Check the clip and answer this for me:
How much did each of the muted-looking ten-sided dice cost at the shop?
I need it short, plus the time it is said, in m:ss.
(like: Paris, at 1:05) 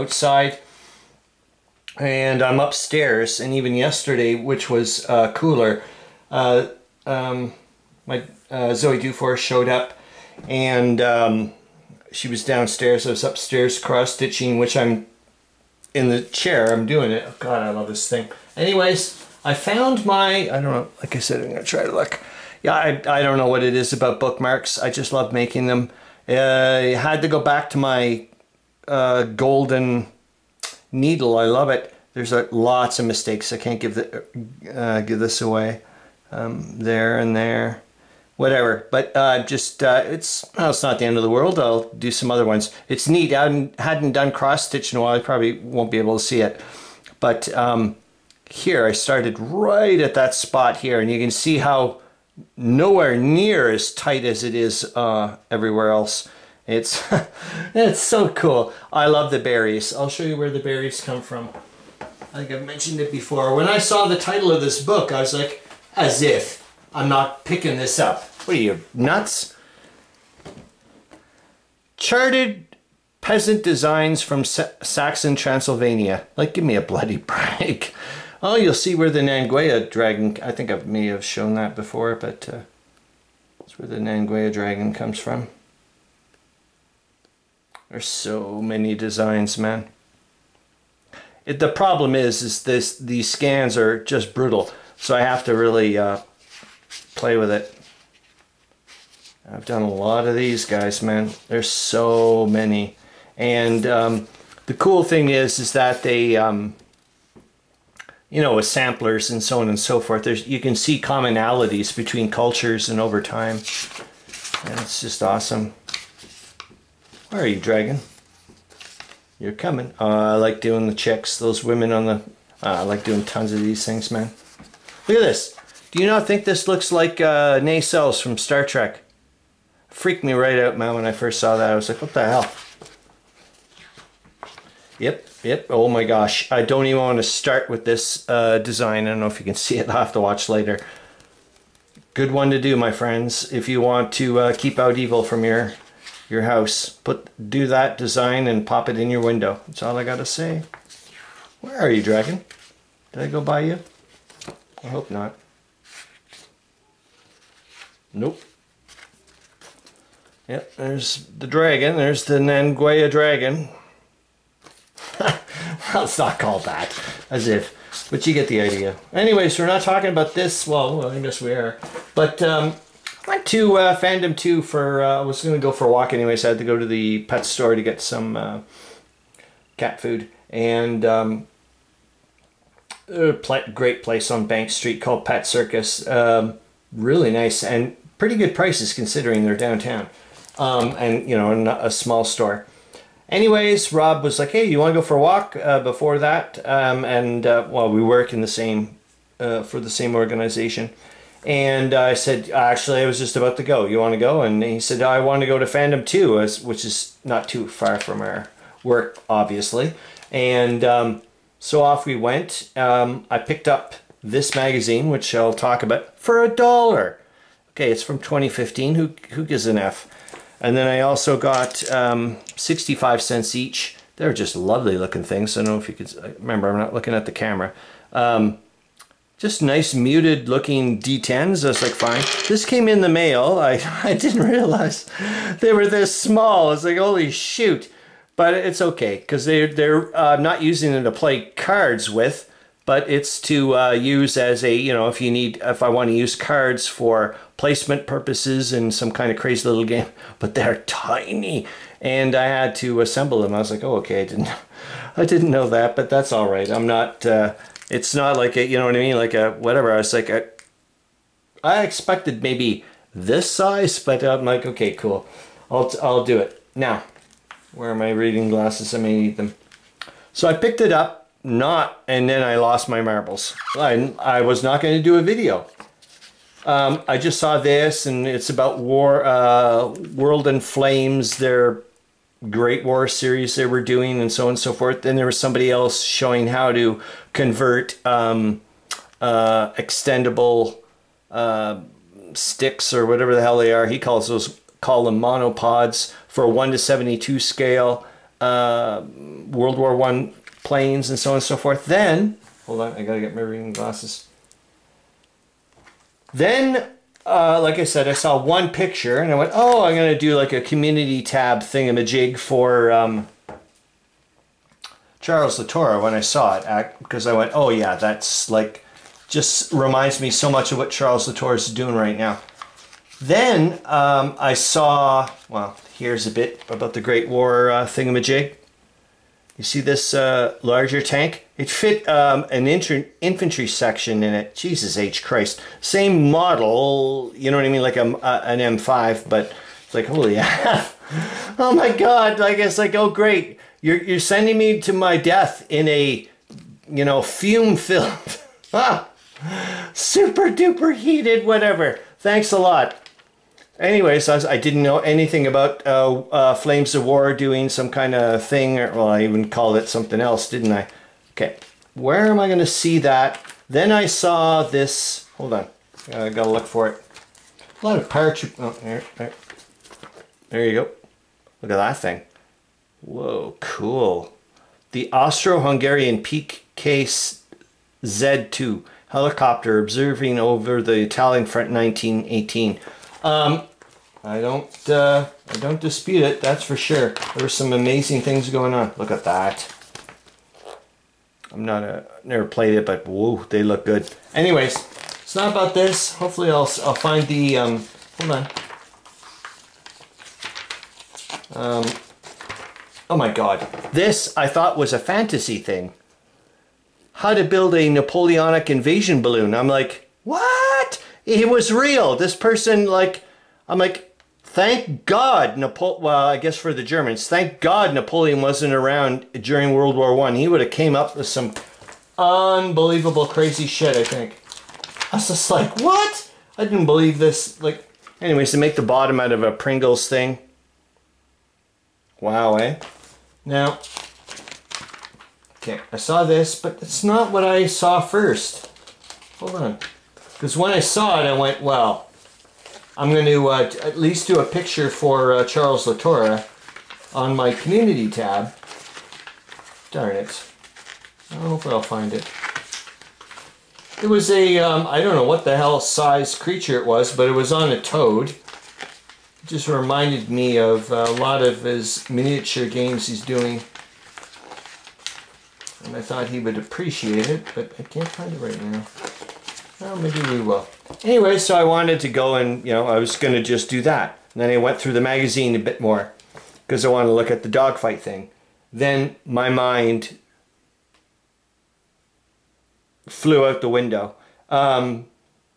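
65 cents, at 3:42.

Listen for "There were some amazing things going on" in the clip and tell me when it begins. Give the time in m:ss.
6:27.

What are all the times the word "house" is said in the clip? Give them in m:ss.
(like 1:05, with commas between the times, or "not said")
2:26.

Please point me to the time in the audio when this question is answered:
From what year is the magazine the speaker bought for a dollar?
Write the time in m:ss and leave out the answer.
3:38.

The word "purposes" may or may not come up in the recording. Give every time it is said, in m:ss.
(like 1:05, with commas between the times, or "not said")
4:08.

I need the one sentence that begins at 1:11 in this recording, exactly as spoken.
Charted Peasant Designs from Sa Saxon Transylvania.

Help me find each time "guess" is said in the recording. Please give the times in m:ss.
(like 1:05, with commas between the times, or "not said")
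2:51, 6:56.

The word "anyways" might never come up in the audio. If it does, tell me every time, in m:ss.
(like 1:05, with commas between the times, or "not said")
0:18, 2:49, 2:56, 3:13, 5:53, 6:34, 7:08, 7:51.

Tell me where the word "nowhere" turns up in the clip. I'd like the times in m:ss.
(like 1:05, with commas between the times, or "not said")
0:52.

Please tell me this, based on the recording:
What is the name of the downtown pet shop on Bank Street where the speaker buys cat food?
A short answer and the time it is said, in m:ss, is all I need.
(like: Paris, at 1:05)
Pet Circus, at 3:05.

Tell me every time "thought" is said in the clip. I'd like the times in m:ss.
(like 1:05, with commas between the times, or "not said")
6:44, 7:46.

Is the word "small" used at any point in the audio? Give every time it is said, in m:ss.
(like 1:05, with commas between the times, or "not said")
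3:11, 3:56.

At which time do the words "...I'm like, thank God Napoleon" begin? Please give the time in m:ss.
6:53.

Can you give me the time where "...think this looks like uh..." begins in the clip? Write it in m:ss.
2:06.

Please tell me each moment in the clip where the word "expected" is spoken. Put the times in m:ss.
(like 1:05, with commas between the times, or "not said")
4:21.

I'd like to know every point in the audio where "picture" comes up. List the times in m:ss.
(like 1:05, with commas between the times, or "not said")
5:08, 7:24.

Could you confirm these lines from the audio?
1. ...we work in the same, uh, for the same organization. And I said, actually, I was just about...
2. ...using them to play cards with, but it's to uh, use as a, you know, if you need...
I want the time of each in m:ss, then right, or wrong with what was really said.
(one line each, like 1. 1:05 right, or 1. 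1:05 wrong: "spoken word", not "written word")
1. 3:17 right
2. 4:00 right.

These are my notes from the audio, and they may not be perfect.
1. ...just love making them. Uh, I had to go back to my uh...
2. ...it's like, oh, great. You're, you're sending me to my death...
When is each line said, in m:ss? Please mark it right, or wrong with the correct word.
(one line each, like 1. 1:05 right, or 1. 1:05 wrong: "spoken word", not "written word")
1. 0:24 right
2. 5:42 right.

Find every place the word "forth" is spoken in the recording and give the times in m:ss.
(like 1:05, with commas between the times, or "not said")
1:49, 4:44, 5:01.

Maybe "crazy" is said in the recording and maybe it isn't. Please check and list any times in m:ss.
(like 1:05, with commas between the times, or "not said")
4:09, 7:03.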